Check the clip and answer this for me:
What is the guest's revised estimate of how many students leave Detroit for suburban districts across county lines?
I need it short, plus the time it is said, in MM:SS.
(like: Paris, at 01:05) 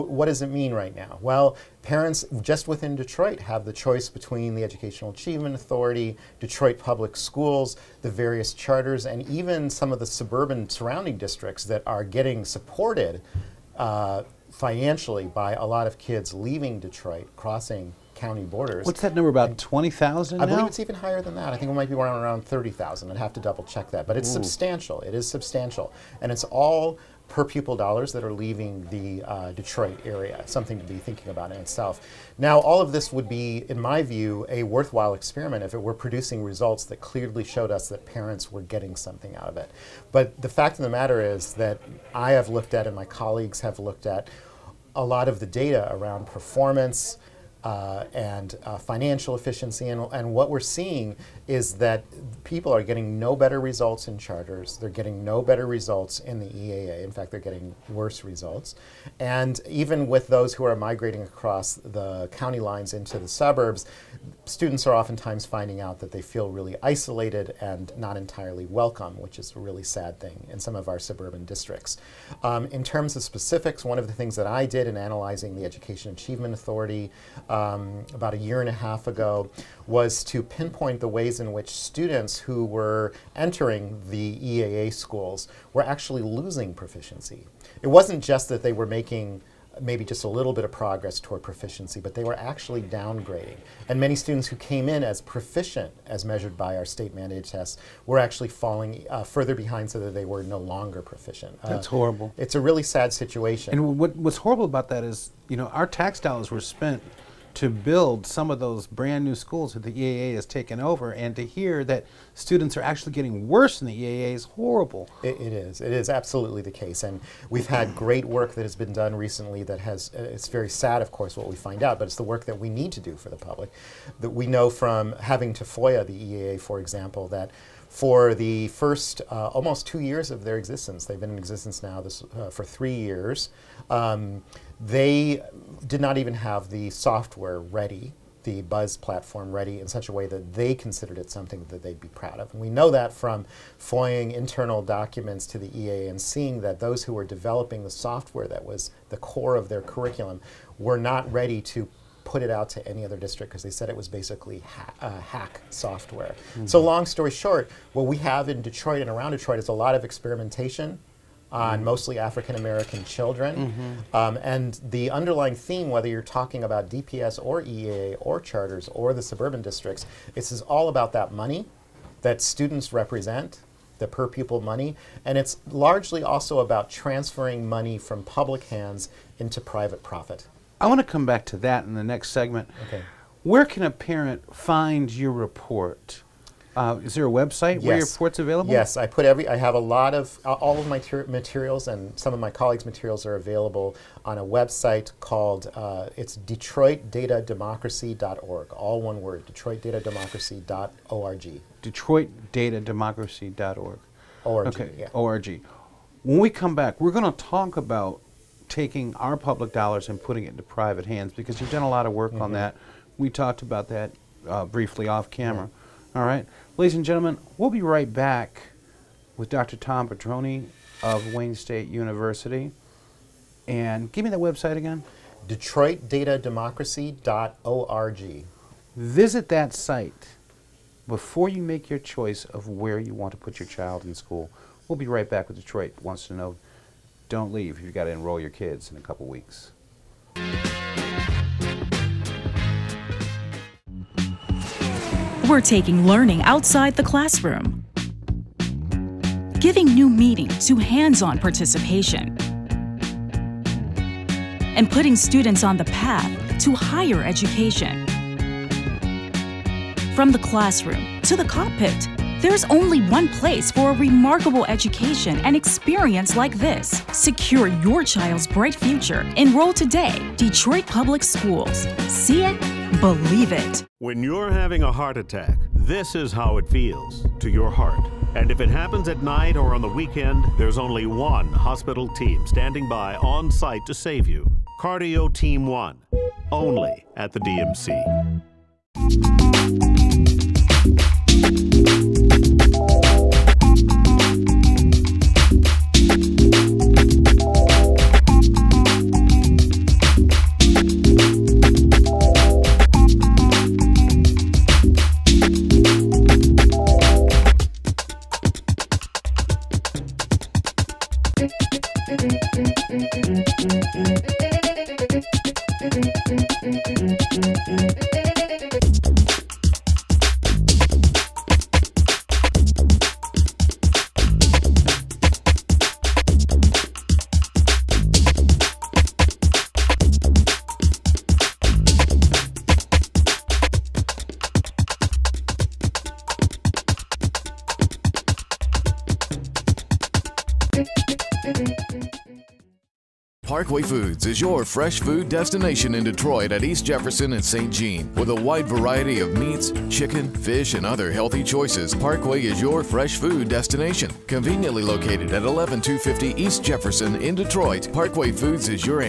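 30,000, at 00:22.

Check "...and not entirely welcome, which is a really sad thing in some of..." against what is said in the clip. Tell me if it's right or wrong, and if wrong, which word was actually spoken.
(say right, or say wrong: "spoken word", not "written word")
right.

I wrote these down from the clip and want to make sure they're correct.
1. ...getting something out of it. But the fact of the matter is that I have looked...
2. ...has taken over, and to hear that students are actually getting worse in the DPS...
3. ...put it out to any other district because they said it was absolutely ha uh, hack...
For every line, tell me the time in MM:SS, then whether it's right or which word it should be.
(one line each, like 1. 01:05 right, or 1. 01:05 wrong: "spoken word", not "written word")
1. 00:38 right
2. 01:50 wrong: "EAA", not "DPS"
3. 02:32 wrong: "basically", not "absolutely".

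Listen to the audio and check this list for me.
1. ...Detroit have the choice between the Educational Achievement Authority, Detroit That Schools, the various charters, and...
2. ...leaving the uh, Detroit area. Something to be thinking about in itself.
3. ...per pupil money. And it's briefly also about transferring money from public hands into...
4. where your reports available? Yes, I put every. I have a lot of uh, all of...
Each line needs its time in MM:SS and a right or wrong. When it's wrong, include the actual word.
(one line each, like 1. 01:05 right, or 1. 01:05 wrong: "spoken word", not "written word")
1. 00:02 wrong: "Public", not "That"
2. 00:28 right
3. 02:54 wrong: "largely", not "briefly"
4. 03:07 right.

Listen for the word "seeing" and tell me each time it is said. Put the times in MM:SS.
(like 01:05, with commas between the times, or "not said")
00:50, 02:26.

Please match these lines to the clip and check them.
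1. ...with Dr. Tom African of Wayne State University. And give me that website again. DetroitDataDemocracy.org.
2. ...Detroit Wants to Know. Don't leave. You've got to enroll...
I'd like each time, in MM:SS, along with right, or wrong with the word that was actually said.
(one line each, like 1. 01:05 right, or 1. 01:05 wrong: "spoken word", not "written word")
1. 03:39 wrong: "Pedroni", not "African"
2. 03:55 right.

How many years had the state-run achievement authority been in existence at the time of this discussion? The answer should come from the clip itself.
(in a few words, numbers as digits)
3 years.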